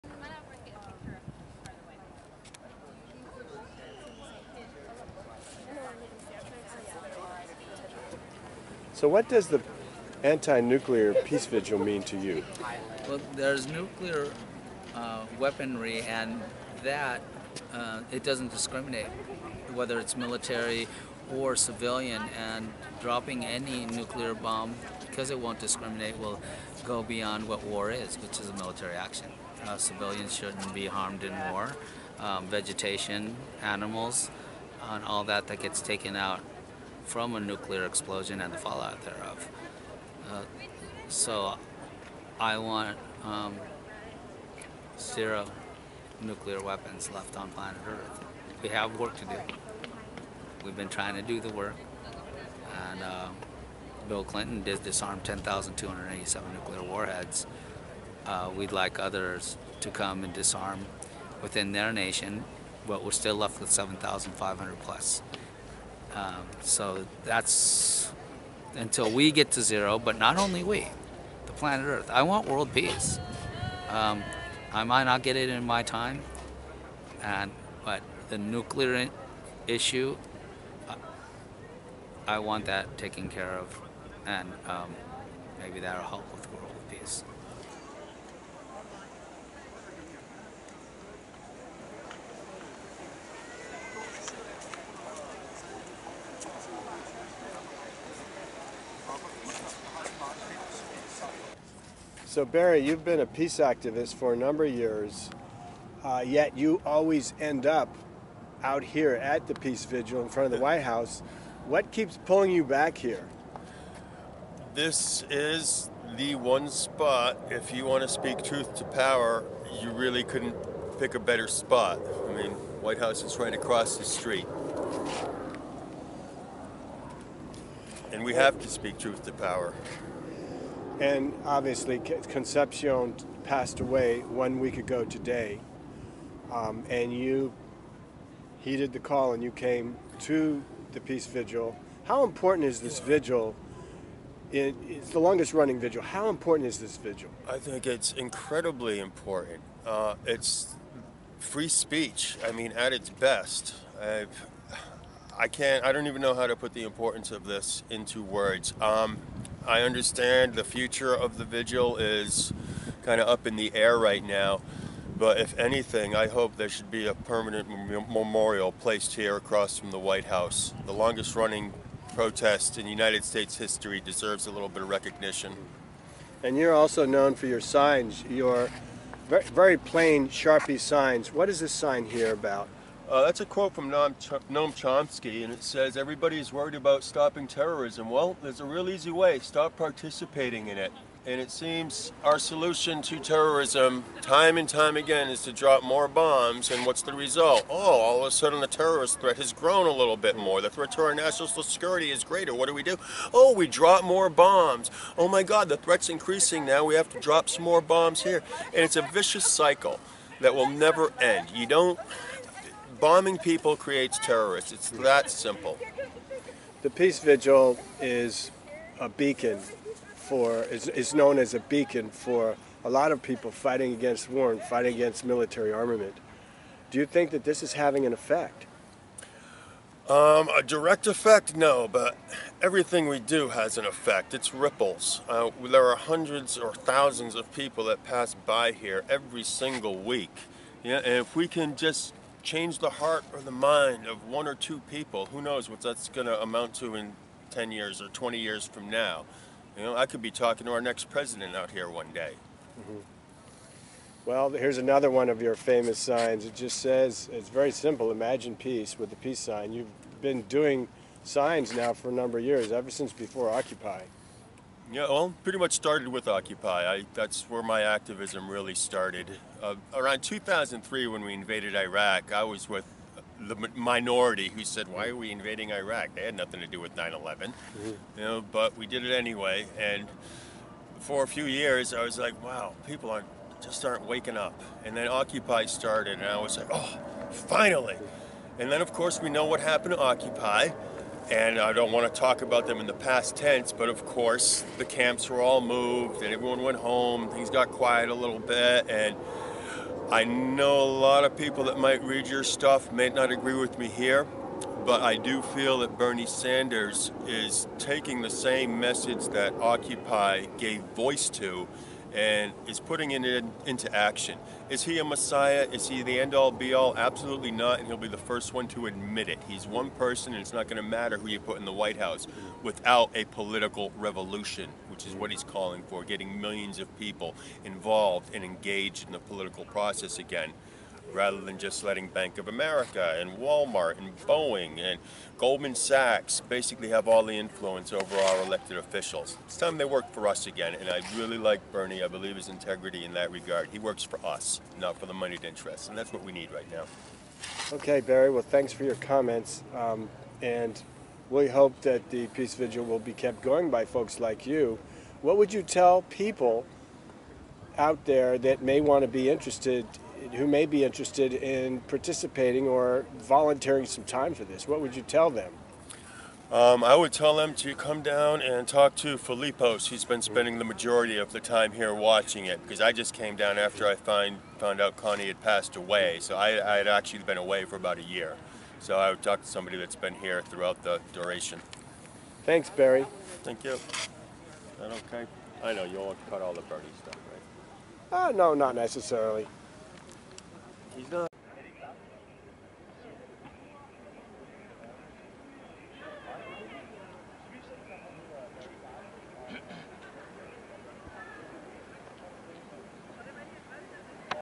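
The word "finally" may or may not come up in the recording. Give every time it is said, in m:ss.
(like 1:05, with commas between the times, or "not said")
4:47.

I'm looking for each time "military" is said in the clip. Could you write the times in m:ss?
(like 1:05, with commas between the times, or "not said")
0:20, 0:28, 3:45.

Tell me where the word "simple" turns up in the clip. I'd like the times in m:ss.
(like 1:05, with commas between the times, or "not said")
3:35, 4:17.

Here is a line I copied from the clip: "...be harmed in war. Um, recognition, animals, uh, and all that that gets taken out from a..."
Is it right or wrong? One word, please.
wrong.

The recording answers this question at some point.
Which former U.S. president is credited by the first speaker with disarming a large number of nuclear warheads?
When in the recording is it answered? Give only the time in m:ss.
0:54.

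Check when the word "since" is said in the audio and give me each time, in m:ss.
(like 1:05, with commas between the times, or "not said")
4:22.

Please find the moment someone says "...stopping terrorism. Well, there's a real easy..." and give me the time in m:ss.
3:07.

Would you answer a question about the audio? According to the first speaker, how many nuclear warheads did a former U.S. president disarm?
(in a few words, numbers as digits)
10,287.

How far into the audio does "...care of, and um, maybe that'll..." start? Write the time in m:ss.
1:23.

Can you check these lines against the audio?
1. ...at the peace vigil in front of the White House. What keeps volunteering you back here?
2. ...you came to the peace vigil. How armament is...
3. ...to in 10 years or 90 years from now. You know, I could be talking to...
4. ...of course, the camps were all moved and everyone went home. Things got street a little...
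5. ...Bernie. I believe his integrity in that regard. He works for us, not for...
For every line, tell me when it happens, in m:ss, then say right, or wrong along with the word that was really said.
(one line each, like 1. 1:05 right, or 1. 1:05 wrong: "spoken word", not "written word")
1. 1:49 wrong: "pulling", not "volunteering"
2. 2:19 wrong: "important", not "armament"
3. 4:06 wrong: "20", not "90"
4. 4:53 wrong: "quiet", not "street"
5. 5:41 right.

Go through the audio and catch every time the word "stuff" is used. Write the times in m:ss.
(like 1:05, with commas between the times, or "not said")
5:02, 6:27.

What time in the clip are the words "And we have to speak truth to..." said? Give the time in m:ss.
2:08.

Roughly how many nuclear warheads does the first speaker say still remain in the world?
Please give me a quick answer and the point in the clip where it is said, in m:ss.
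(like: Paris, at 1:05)
7,500 plus, at 1:03.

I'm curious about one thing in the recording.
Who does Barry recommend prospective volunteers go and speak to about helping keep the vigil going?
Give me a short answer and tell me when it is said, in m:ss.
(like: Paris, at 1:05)
Philipos, at 6:09.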